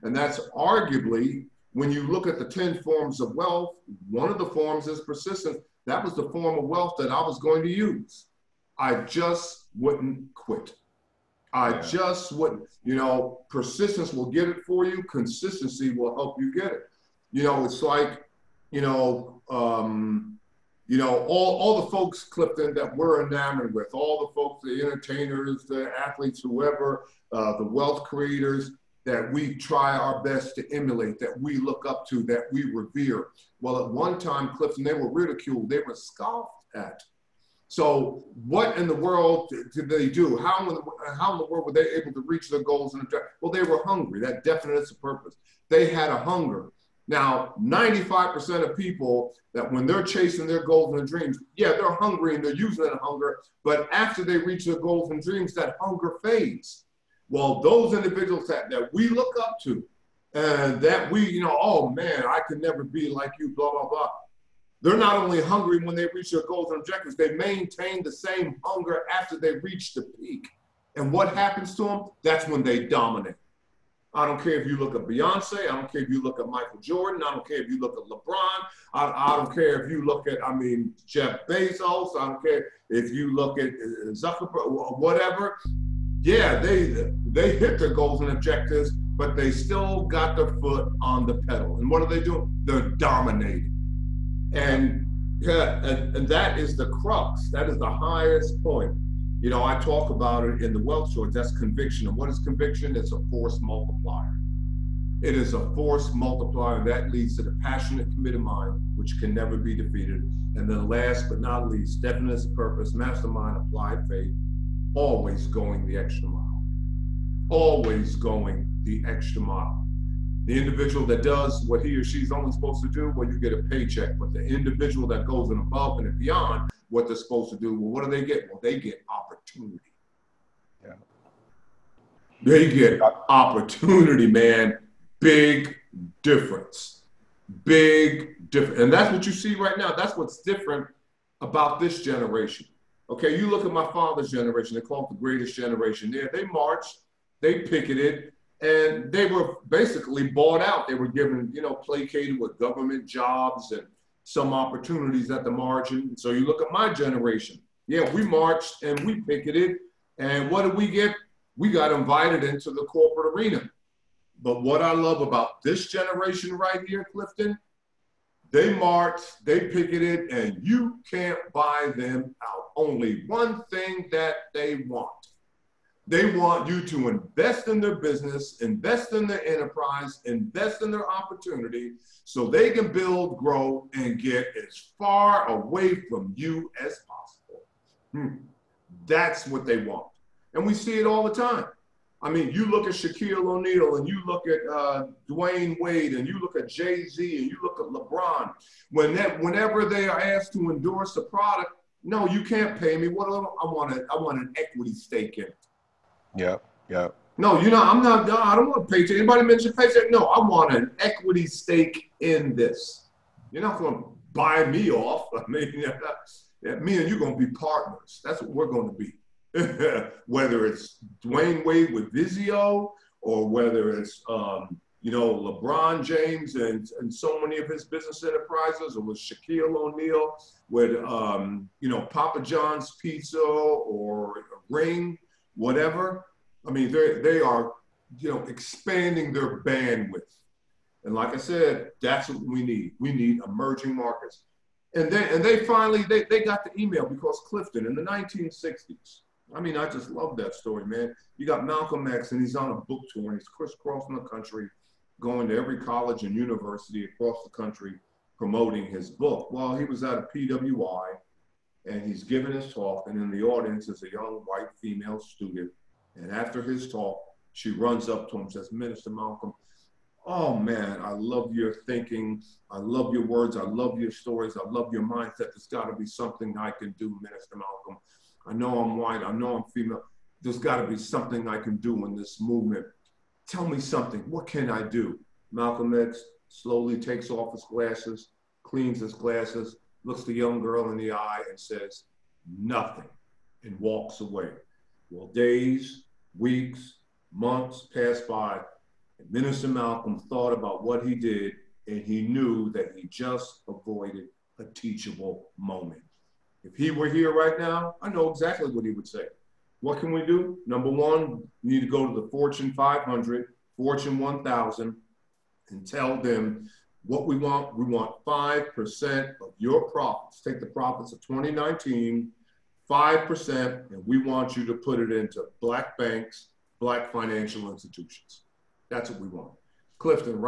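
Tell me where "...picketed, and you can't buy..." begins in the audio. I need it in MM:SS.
02:49.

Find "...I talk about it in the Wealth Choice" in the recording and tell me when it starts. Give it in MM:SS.
01:39.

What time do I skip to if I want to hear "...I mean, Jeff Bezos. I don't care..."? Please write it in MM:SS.
01:20.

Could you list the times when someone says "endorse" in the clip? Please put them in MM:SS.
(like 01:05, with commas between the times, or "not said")
03:20.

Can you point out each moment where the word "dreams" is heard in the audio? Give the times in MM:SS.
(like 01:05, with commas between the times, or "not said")
00:51, 00:55.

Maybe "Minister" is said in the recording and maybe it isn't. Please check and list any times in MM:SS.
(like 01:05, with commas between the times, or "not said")
04:28, 04:37, 04:59.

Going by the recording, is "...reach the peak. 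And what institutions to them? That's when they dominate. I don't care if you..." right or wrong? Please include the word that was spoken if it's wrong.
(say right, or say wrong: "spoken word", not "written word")
wrong: "happens", not "institutions".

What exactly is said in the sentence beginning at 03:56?
I mean, they they are, you know, expanding their bandwidth.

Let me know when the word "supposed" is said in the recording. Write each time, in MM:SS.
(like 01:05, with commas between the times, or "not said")
02:02, 02:07.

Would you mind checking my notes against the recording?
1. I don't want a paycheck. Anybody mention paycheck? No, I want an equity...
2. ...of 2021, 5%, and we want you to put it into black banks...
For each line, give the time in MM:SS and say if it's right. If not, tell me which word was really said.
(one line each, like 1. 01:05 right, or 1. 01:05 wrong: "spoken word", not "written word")
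1. 03:28 right
2. 05:21 wrong: "2019", not "2021".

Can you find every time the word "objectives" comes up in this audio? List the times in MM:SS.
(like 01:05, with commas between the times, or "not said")
00:43, 01:06, 01:28.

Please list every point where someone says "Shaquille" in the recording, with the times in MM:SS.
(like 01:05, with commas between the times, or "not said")
03:12, 03:49.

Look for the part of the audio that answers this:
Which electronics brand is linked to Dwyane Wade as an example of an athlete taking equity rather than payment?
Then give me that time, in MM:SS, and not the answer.
03:42.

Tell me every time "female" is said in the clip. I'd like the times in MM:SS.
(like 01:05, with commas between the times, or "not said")
04:24, 04:39.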